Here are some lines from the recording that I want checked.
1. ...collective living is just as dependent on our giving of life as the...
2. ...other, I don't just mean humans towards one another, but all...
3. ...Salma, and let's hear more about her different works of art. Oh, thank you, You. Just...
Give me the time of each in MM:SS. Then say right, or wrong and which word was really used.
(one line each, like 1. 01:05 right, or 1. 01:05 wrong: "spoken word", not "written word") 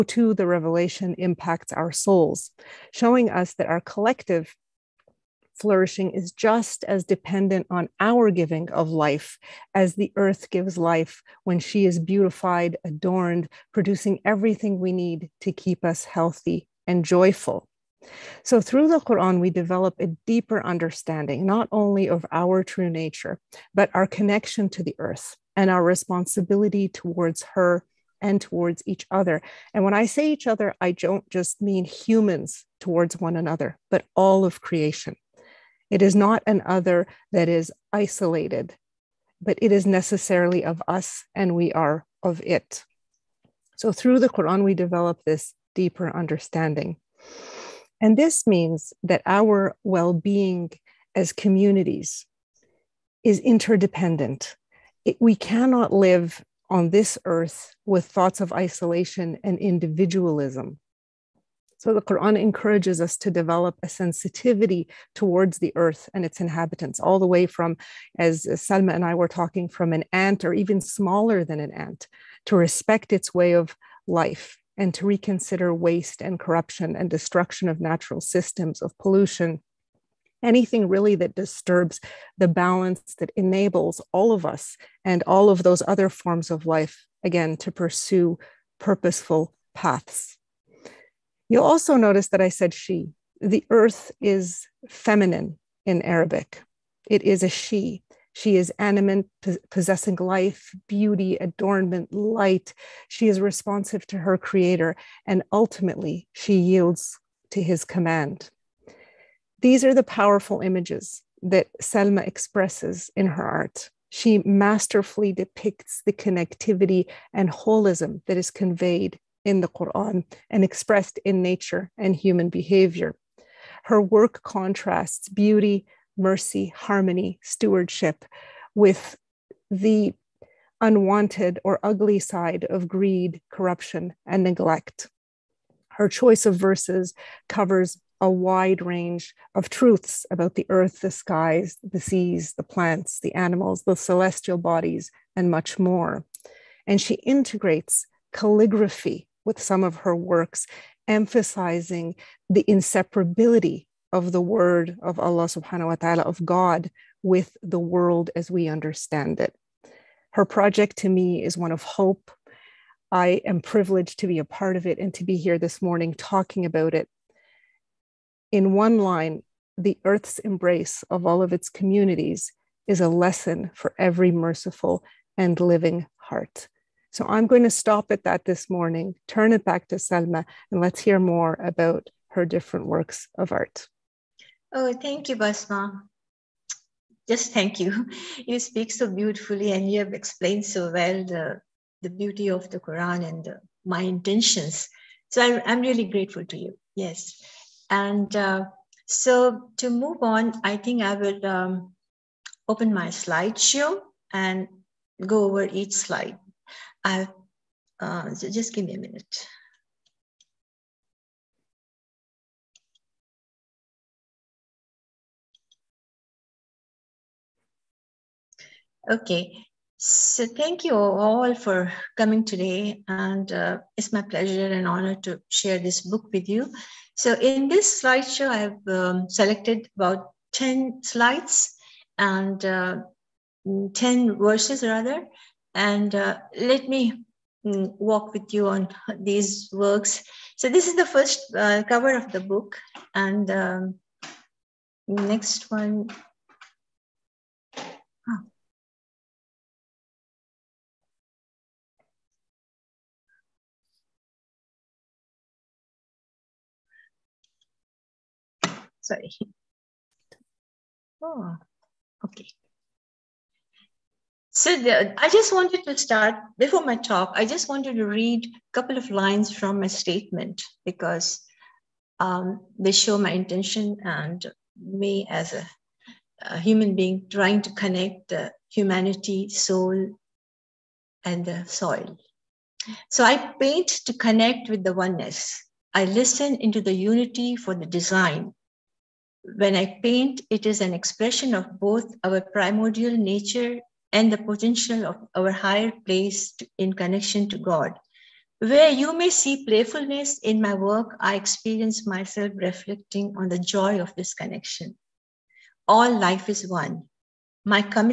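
1. 00:03 wrong: "flourishing", not "living"
2. 00:30 right
3. 02:59 wrong: "Basma", not "You".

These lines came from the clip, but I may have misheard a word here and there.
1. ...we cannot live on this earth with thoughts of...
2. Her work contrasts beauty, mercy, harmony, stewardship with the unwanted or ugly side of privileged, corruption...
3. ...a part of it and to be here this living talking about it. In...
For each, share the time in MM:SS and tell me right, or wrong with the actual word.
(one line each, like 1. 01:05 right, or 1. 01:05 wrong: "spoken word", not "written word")
1. 00:55 right
2. 02:03 wrong: "greed", not "privileged"
3. 02:44 wrong: "morning", not "living".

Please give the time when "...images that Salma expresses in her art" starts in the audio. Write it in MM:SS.
01:50.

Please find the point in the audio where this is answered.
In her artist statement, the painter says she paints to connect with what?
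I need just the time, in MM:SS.
04:44.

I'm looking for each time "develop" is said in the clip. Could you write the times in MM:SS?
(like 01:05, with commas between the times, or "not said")
00:19, 00:44, 01:03.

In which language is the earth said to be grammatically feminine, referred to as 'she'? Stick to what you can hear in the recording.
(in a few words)
Arabic.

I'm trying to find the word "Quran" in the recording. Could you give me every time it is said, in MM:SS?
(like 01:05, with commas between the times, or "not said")
00:19, 00:44, 01:02, 01:59, 03:12.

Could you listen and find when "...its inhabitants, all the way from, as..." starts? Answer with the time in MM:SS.
01:06.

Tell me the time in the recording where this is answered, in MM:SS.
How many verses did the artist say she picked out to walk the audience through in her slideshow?
03:53.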